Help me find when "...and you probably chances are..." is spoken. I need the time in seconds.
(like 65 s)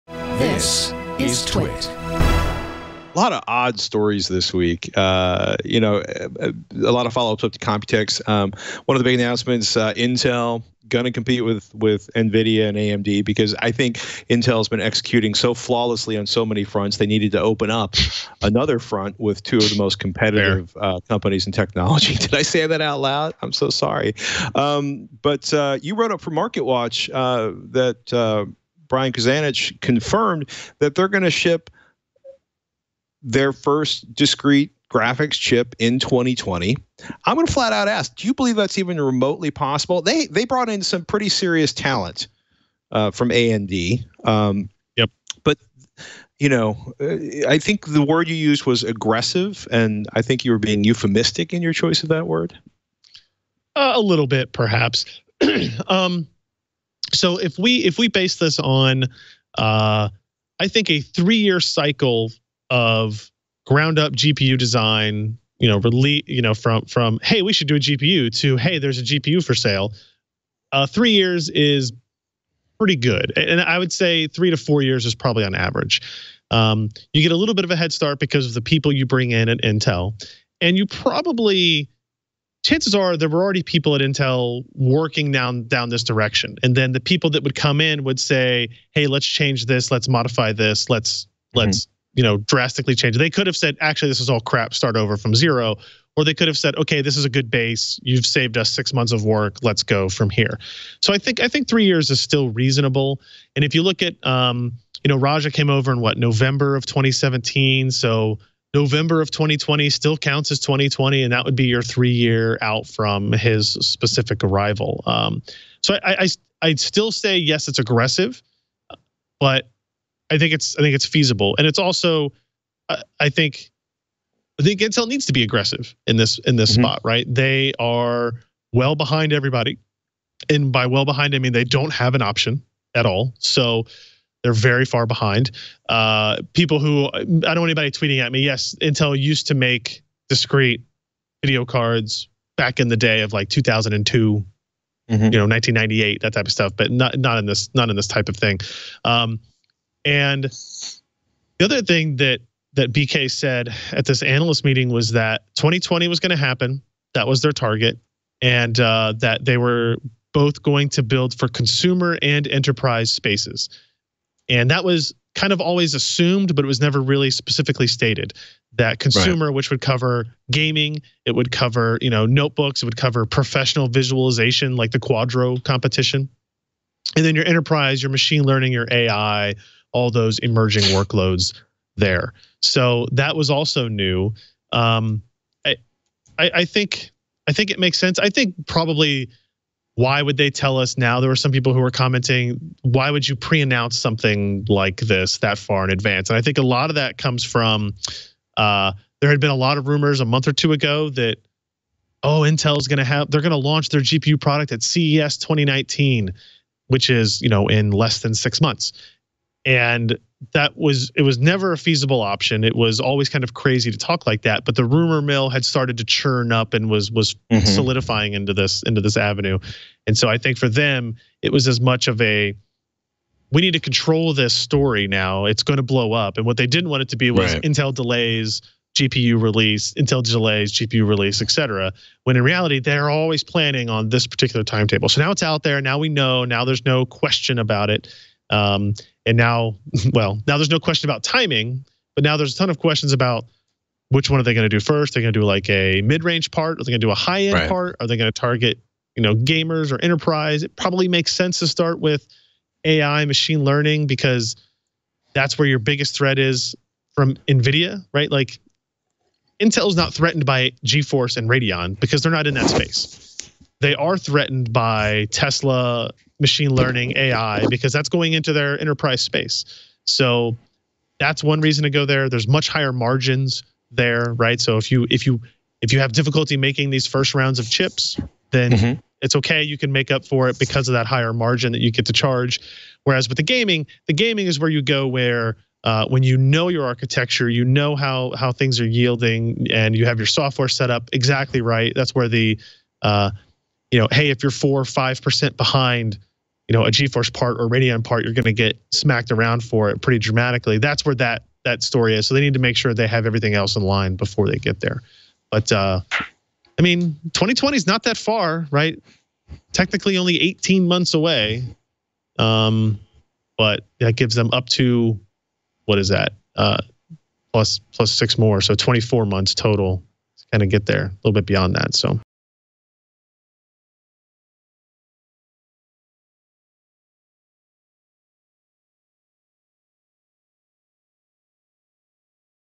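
80 s.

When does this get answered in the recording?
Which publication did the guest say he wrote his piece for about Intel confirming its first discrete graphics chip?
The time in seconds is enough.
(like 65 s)
26 s.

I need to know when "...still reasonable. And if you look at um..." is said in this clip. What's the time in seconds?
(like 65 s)
102 s.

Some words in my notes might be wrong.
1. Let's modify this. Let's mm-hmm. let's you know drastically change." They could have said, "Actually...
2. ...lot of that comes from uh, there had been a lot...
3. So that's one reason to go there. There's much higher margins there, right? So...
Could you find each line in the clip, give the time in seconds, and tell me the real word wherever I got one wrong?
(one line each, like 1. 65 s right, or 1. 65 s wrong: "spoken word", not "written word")
1. 89 s right
2. 196 s right
3. 270 s right.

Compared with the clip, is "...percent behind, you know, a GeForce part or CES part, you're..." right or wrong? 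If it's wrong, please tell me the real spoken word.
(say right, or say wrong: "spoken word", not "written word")
wrong: "Radeon", not "CES".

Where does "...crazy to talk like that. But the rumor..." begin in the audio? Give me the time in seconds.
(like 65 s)
213 s.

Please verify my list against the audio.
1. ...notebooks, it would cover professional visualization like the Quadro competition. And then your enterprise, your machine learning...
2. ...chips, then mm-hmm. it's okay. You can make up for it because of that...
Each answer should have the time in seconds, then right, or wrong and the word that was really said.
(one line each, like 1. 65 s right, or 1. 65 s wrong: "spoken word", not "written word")
1. 172 s right
2. 277 s right.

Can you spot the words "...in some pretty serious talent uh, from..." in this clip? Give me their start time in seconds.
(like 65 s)
40 s.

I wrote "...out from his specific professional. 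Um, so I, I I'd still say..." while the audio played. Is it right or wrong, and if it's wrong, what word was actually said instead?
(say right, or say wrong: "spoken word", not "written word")
wrong: "arrival", not "professional".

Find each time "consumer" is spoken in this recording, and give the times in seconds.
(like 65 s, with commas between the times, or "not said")
161 s, 168 s.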